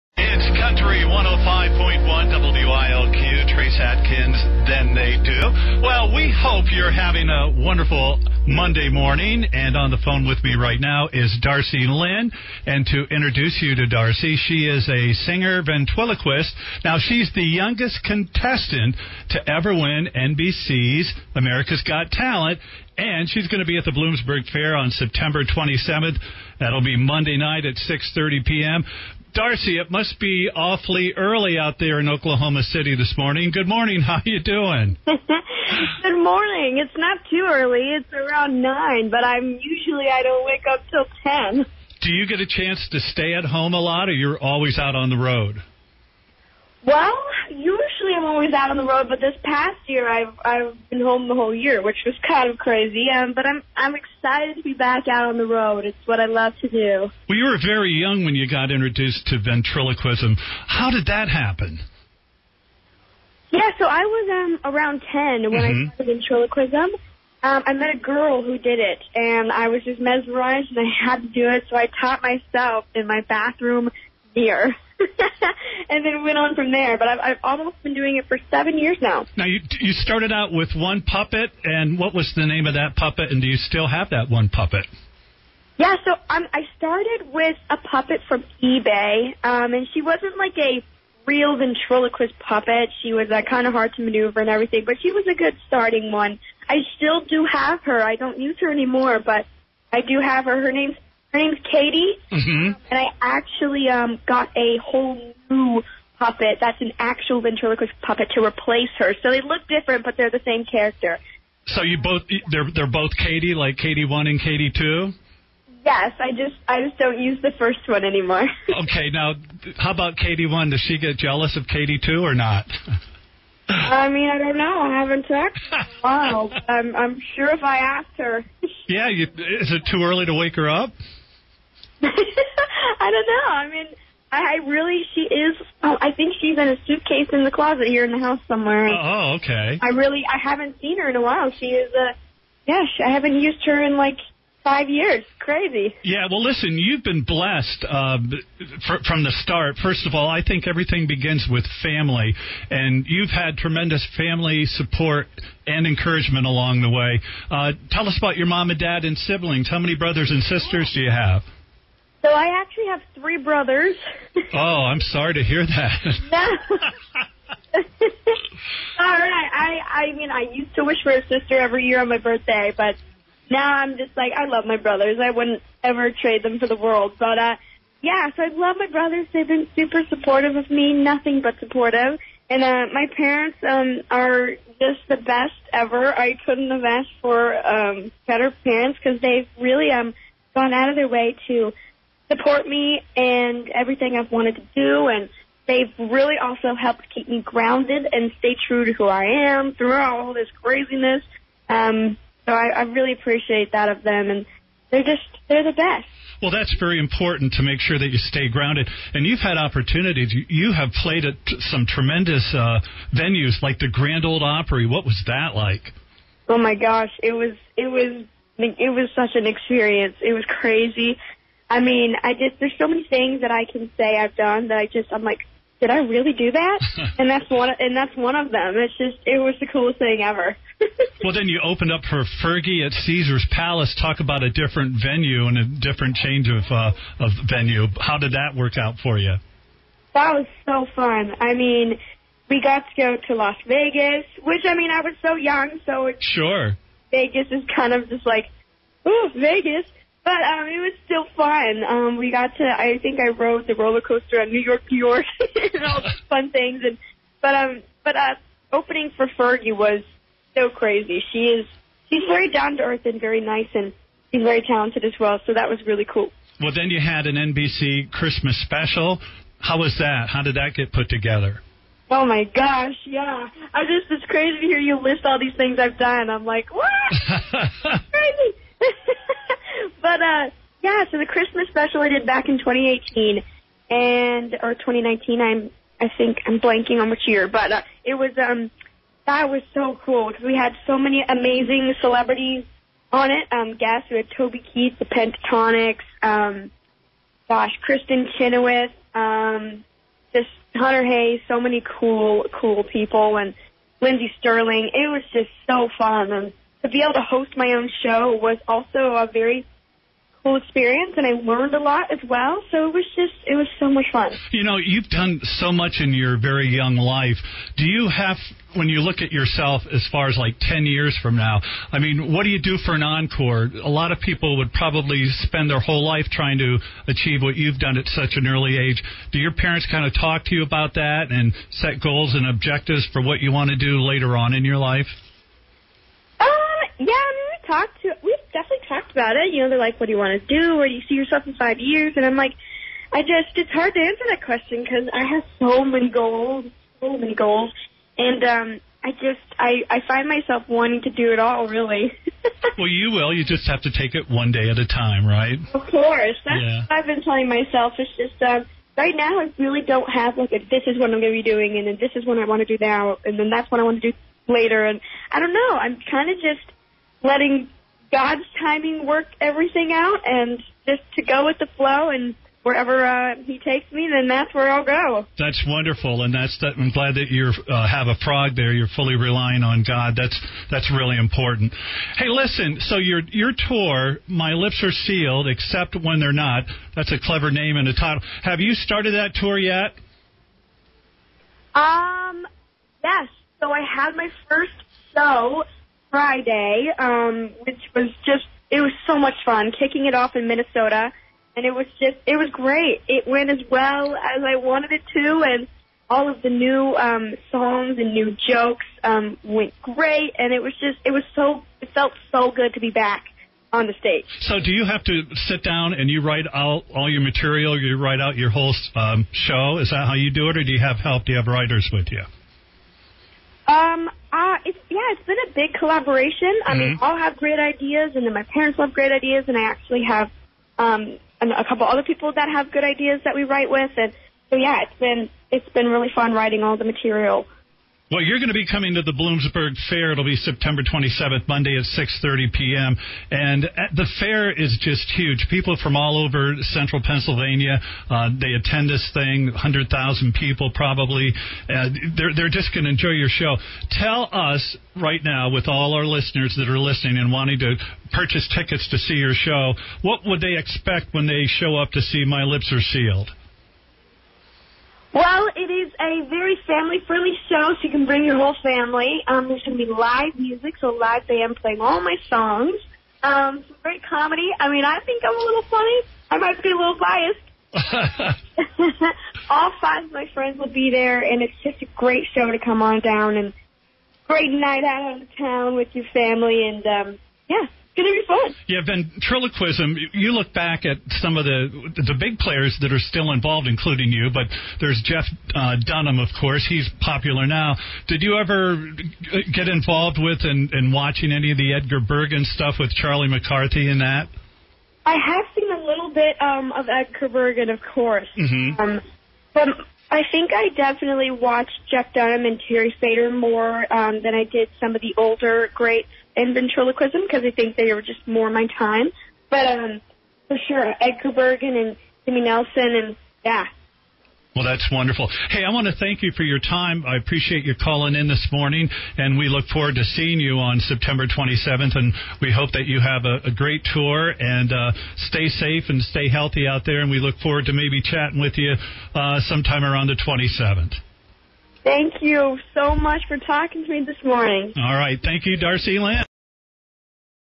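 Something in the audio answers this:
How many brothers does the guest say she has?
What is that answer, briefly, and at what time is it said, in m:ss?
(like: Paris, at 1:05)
3, at 2:43.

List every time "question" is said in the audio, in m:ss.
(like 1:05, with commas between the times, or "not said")
5:44.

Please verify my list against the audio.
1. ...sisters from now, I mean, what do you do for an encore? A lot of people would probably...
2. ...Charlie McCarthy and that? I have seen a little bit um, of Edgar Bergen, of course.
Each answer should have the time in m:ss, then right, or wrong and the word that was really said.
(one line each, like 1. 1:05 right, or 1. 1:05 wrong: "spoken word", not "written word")
1. 5:20 wrong: "years", not "sisters"
2. 8:22 right.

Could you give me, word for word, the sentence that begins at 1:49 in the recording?
So they look different, but they're the same character.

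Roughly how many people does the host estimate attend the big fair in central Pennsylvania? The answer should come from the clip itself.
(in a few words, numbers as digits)
100,000.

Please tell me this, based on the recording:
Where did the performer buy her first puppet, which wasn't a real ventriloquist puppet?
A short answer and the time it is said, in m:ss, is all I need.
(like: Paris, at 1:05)
eBay, at 1:28.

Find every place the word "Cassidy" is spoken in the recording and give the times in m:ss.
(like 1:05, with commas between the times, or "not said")
not said.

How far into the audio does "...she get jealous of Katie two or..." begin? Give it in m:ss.
2:00.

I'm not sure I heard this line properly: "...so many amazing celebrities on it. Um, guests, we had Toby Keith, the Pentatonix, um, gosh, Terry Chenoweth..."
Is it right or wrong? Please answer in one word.
wrong.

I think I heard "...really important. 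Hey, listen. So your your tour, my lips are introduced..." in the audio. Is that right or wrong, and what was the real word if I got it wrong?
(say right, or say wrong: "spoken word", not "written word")
wrong: "sealed", not "introduced".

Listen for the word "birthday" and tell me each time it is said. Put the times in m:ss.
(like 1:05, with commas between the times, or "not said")
2:52.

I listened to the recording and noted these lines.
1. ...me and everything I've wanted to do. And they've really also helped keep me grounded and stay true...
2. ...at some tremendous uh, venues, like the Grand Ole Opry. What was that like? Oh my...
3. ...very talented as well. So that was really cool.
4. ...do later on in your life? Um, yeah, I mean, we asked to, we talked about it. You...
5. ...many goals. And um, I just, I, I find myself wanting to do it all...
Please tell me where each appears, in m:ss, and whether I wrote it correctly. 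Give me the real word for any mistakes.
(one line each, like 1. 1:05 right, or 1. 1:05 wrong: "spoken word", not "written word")
1. 3:12 right
2. 3:31 right
3. 4:24 right
4. 5:33 wrong: "talked", not "asked"
5. 5:47 right.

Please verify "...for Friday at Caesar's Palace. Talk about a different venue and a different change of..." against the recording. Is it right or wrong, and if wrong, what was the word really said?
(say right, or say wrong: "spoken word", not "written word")
wrong: "Fergie", not "Friday".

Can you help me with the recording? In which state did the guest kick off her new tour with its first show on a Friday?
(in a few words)
Minnesota.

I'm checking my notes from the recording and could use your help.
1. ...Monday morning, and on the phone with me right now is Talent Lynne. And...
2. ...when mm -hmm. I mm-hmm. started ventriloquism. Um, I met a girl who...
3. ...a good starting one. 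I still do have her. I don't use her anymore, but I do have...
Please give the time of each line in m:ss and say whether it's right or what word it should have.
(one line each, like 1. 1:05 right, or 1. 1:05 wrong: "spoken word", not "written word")
1. 0:08 wrong: "Darci", not "Talent"
2. 1:05 right
3. 1:35 right.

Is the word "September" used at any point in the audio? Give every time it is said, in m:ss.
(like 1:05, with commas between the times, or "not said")
0:24, 7:20, 8:50.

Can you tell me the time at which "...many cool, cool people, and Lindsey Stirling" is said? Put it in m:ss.
5:01.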